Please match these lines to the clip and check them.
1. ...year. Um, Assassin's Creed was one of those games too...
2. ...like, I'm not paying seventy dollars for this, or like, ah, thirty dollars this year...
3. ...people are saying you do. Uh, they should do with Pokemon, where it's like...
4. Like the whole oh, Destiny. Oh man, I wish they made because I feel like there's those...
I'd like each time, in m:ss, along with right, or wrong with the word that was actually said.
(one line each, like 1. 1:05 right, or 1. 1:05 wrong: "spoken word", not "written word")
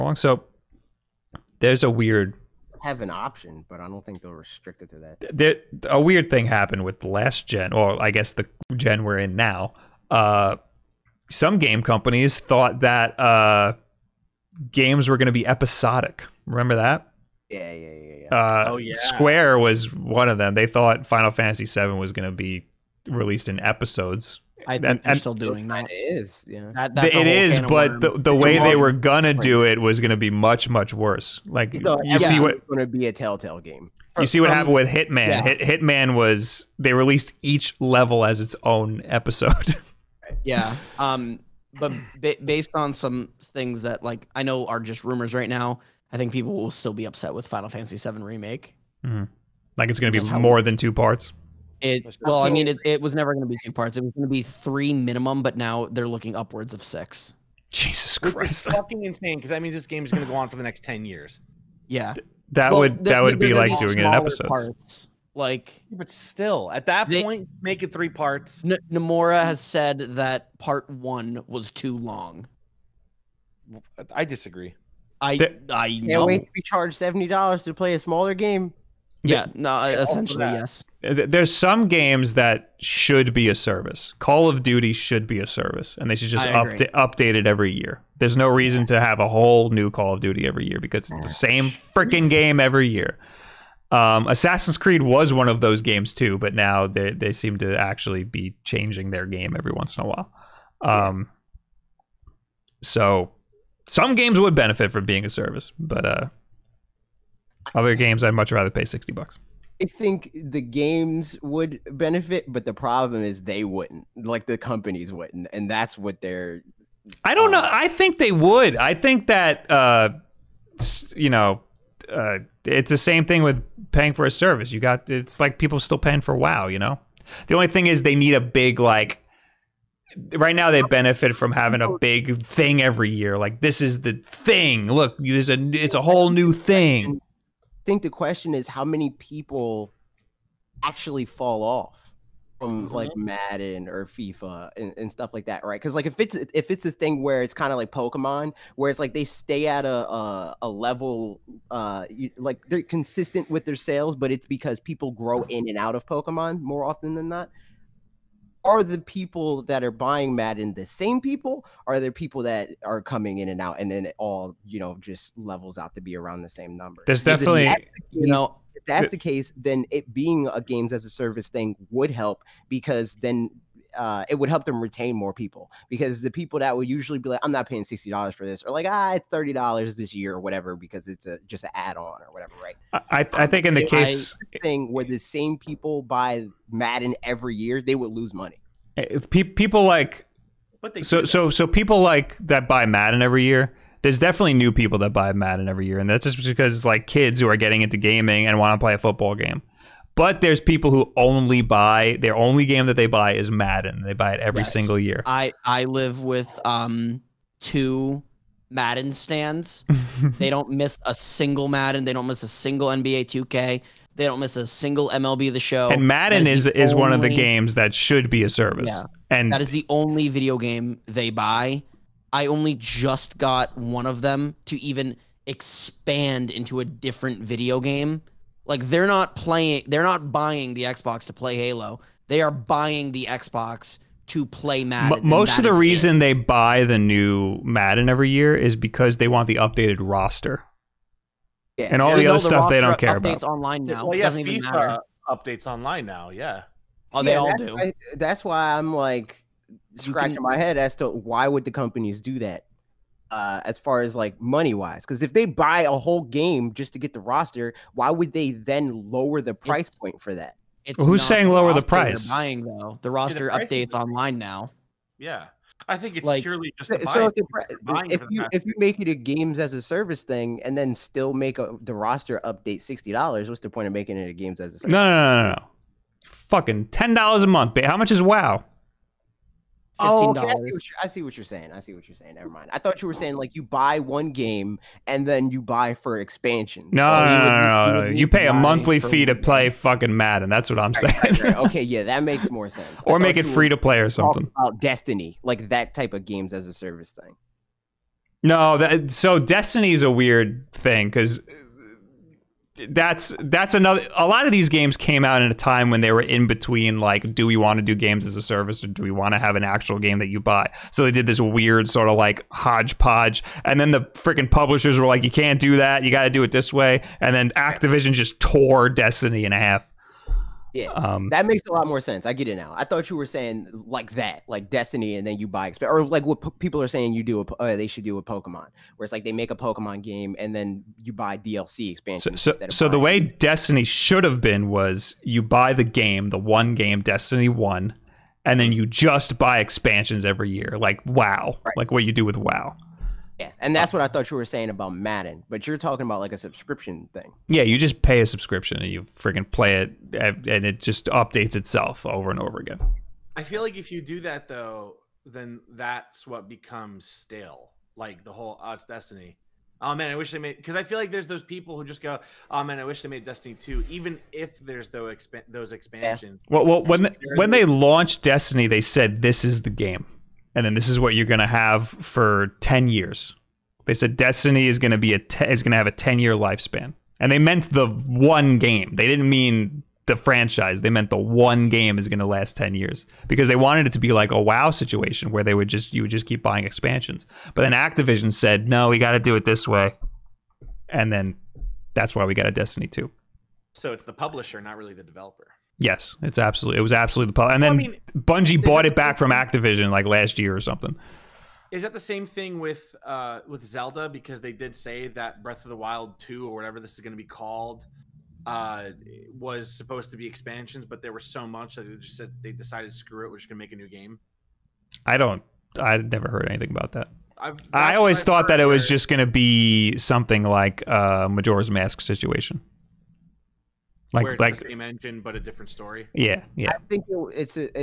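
1. 1:32 right
2. 2:57 wrong: "sixty", not "seventy"
3. 5:26 right
4. 5:57 right.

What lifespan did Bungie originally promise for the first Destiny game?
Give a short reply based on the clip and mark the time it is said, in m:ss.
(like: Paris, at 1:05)
10 years, at 6:15.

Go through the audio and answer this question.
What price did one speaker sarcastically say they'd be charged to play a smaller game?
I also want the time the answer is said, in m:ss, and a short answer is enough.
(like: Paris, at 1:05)
70 dollars, at 1:16.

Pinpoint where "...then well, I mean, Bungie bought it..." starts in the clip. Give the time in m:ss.
6:37.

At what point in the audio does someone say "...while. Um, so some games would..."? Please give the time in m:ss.
1:40.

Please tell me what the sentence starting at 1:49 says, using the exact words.
I think the games would benefit, but the problem is they wouldn't.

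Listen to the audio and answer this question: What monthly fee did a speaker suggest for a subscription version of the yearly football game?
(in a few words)
10 dollars.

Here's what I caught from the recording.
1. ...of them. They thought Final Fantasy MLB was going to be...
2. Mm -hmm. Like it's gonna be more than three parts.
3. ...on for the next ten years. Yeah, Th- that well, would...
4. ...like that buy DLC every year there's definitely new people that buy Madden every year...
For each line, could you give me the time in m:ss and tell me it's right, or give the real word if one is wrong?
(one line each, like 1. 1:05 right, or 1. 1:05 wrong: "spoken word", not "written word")
1. 0:20 wrong: "VII", not "MLB"
2. 0:49 wrong: "two", not "three"
3. 1:00 right
4. 3:12 wrong: "Madden", not "DLC".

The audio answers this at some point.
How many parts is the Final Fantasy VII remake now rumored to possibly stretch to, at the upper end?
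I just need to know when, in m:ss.
0:56.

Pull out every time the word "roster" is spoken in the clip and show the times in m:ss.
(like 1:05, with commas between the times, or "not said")
3:59, 4:17, 4:23, 4:31.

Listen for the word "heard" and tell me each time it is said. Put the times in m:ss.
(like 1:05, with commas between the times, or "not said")
6:56.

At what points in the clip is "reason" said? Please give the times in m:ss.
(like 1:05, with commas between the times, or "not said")
1:28, 3:55.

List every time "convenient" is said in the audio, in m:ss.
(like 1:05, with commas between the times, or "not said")
not said.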